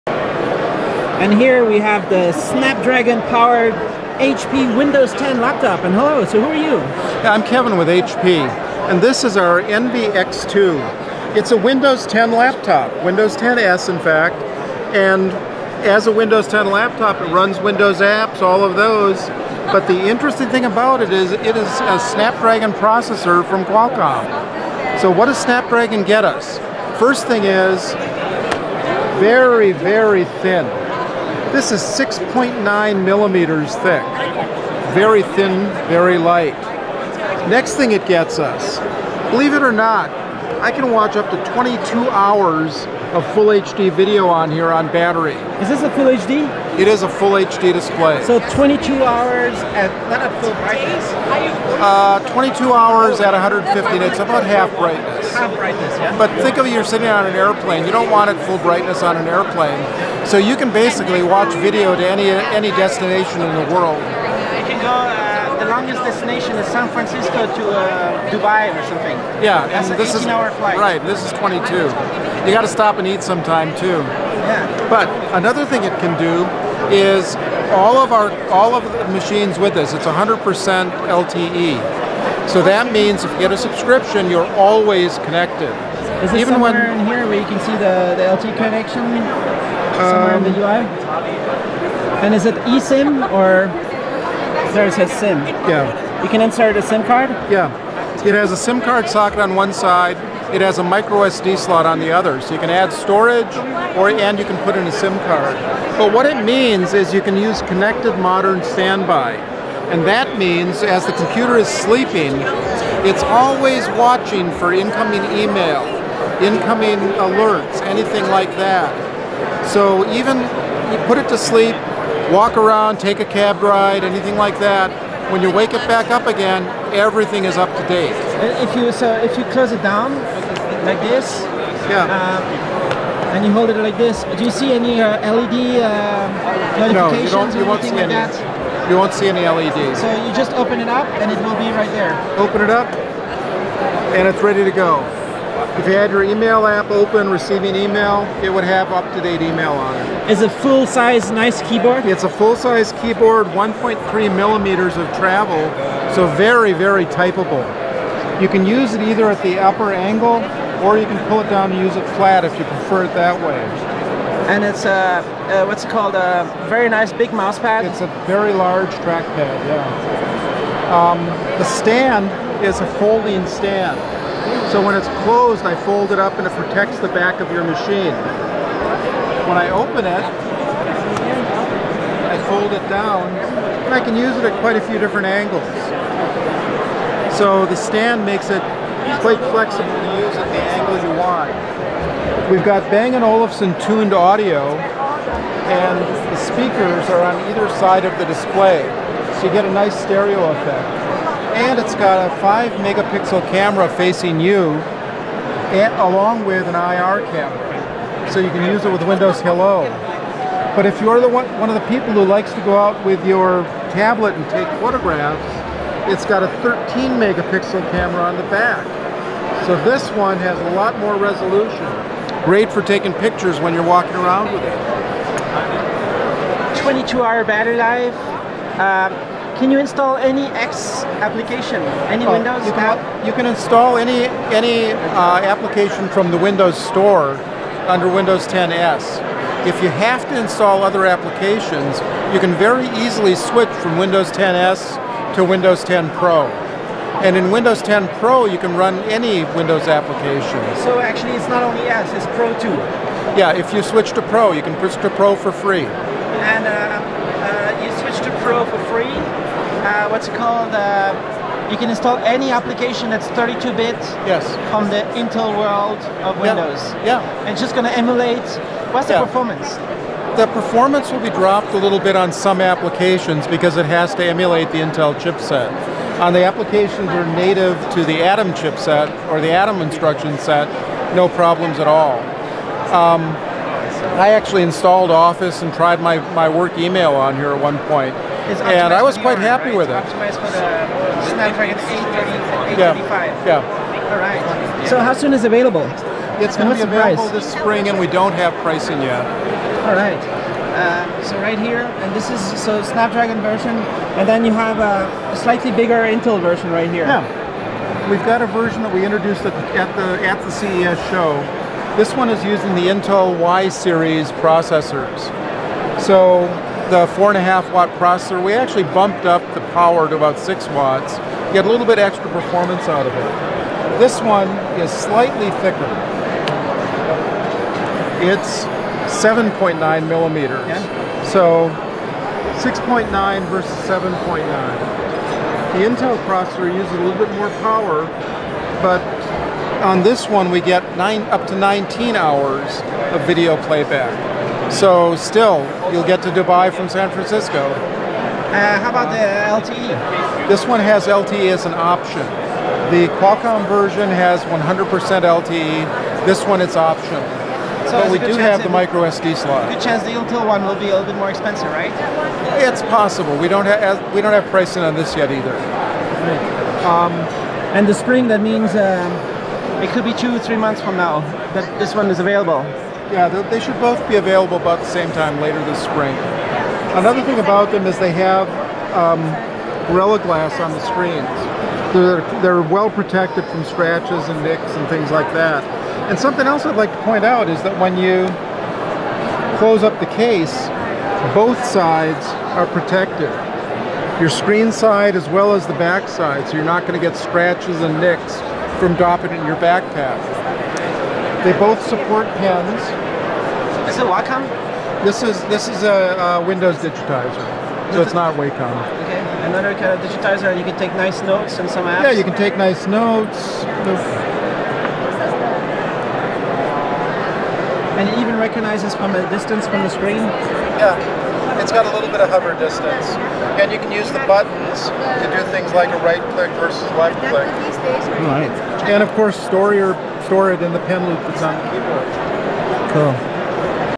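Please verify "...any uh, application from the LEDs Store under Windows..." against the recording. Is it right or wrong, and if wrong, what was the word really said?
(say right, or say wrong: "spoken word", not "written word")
wrong: "Windows", not "LEDs".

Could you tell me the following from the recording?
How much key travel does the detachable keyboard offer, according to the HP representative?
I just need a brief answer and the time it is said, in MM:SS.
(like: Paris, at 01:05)
1.3 millimeters, at 02:33.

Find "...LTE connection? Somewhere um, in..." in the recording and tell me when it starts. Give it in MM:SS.
01:28.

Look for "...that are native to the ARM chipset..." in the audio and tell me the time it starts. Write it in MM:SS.
04:37.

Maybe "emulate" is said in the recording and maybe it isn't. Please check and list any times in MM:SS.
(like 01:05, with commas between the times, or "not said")
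04:27, 04:34.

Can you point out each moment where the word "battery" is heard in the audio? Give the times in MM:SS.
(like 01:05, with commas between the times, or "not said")
00:44, 03:47.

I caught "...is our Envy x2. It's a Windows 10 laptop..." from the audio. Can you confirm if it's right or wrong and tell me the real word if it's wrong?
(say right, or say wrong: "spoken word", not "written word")
right.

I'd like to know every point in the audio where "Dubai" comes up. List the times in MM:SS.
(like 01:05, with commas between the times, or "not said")
01:08, 05:46.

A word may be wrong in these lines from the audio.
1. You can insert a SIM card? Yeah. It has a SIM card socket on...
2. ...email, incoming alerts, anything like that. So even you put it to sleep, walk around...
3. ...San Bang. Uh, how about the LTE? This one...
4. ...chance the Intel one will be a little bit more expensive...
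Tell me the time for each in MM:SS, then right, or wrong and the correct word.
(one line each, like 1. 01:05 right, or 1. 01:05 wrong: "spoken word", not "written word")
1. 01:36 right
2. 01:55 right
3. 05:46 wrong: "Francisco", not "Bang"
4. 05:59 right.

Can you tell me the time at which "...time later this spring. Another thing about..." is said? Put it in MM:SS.
06:15.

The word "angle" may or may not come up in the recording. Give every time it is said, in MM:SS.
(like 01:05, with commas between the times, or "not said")
02:39, 03:05, 03:10.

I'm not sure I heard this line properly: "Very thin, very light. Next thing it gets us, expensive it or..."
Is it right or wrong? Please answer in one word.
wrong.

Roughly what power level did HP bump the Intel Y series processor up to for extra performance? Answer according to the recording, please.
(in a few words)
6 watts.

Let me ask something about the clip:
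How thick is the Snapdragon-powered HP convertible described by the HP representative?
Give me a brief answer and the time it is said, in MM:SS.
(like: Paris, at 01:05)
6.9 millimeters, at 00:31.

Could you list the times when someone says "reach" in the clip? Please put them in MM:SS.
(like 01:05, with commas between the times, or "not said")
not said.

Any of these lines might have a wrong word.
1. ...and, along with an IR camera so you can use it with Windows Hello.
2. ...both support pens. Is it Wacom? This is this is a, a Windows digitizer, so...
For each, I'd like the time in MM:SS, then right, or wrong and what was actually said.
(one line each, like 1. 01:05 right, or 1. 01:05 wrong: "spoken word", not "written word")
1. 03:25 right
2. 06:41 right.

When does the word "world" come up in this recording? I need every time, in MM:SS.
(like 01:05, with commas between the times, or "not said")
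01:03, 04:25.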